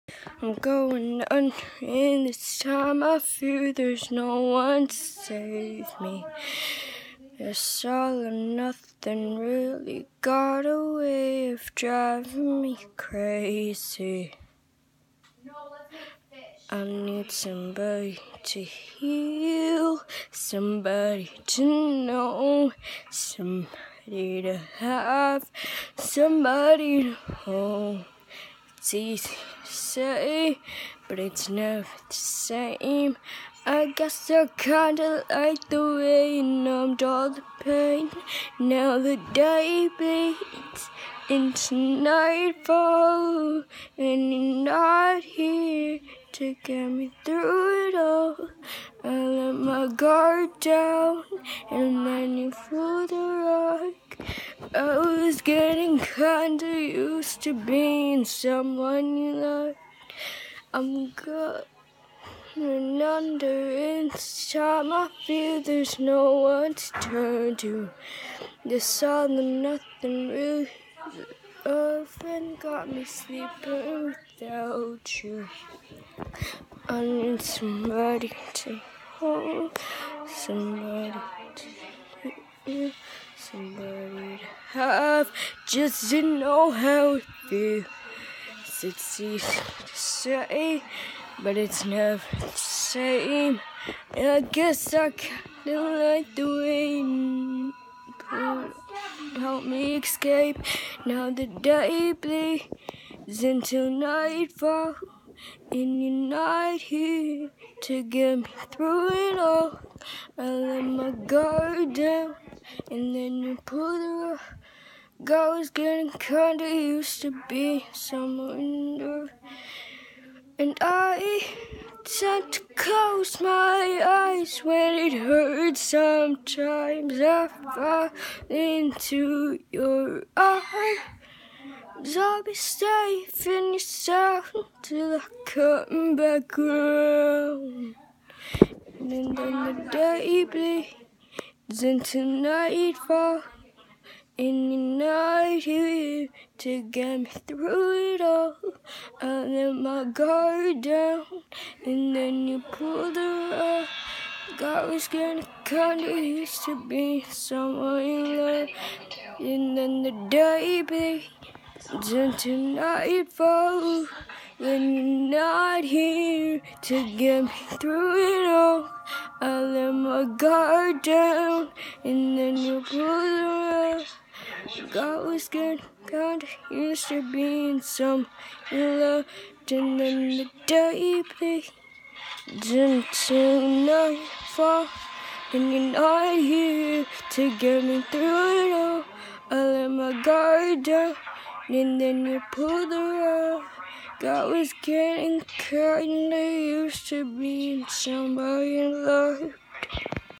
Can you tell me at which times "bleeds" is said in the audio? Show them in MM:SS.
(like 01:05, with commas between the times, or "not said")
01:42, 02:20, 02:40.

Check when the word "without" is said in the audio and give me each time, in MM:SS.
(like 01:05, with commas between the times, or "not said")
01:14.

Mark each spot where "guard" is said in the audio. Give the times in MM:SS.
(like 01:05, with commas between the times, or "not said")
00:49, 01:51, 02:30, 02:50, 03:10.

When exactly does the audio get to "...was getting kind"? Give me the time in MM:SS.
03:14.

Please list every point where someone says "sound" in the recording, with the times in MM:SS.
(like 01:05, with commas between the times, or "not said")
02:13.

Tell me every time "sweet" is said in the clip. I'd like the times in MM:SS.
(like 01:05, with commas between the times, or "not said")
not said.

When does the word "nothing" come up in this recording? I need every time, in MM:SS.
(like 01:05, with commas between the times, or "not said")
00:08, 01:09.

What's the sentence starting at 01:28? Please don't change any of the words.
It's easy to say, but it's never the same.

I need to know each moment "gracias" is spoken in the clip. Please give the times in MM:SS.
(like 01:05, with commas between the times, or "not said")
not said.